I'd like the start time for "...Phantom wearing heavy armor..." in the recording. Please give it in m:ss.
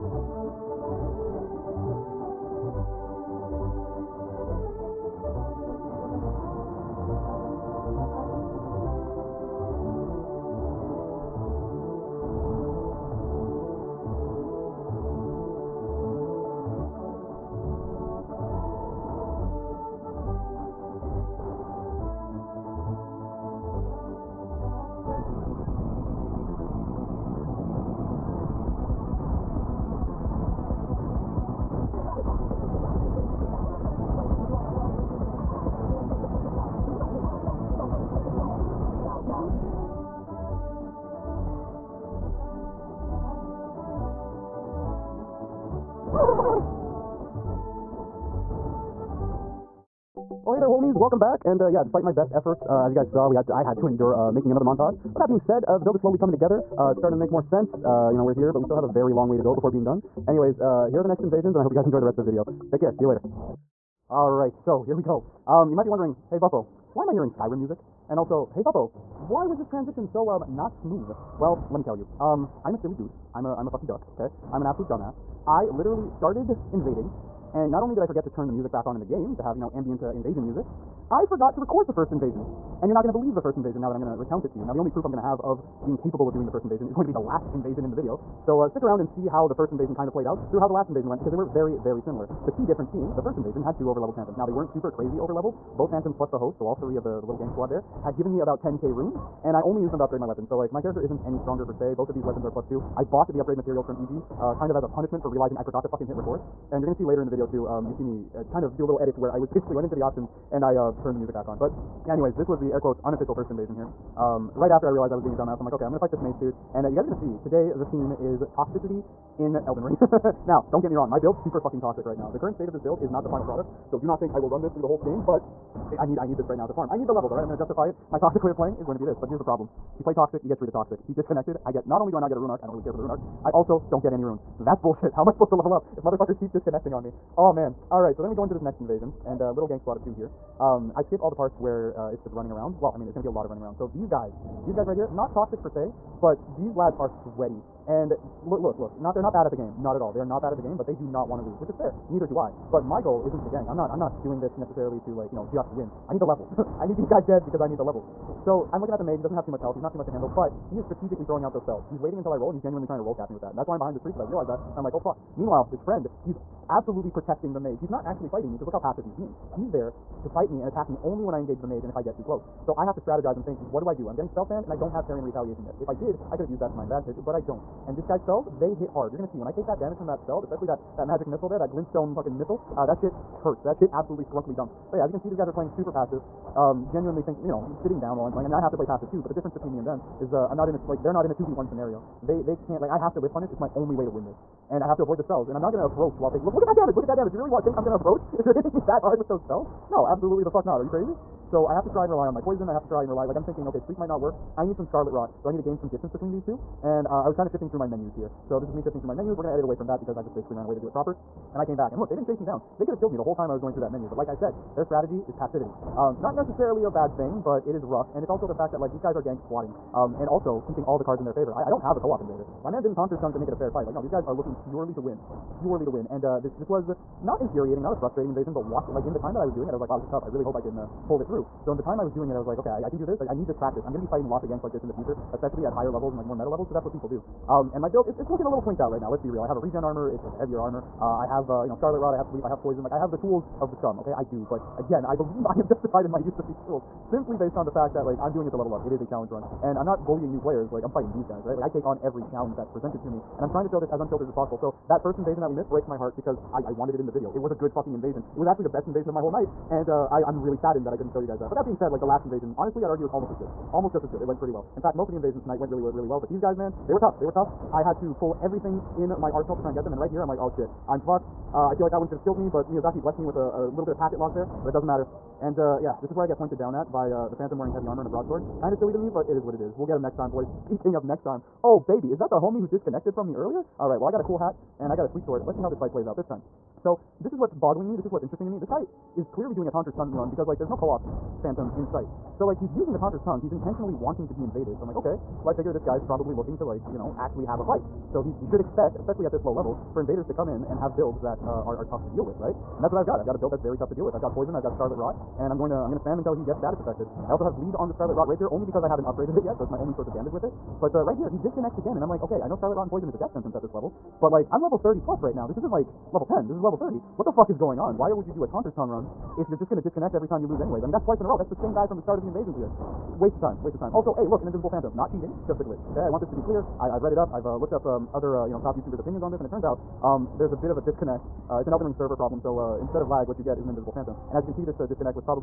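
4:37.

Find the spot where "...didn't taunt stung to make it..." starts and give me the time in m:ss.
3:42.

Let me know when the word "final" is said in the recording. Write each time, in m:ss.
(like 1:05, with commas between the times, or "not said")
2:03.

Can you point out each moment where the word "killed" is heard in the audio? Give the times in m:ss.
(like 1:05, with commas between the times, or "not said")
3:32, 4:32.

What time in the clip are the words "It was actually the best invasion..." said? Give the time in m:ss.
4:18.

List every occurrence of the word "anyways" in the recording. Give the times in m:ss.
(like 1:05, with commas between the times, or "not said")
1:00, 1:52, 5:20.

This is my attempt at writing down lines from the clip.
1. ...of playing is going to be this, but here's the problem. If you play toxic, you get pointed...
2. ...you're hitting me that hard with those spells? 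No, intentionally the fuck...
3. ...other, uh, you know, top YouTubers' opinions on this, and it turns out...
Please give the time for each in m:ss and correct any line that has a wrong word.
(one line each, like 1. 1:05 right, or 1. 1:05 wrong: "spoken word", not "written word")
1. 2:08 wrong: "treated", not "pointed"
2. 3:18 wrong: "absolutely", not "intentionally"
3. 5:28 right.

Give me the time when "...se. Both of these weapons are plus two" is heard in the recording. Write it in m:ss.
1:41.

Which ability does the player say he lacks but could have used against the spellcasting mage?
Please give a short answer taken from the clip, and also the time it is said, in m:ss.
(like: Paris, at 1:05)
Carrion Retaliation, at 2:55.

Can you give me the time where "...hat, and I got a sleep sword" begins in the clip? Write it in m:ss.
4:44.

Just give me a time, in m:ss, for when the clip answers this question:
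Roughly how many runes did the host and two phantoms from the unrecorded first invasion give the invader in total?
1:38.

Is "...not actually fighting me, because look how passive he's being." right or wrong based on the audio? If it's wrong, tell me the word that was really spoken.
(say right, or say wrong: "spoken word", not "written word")
right.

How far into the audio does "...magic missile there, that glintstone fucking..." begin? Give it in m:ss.
3:01.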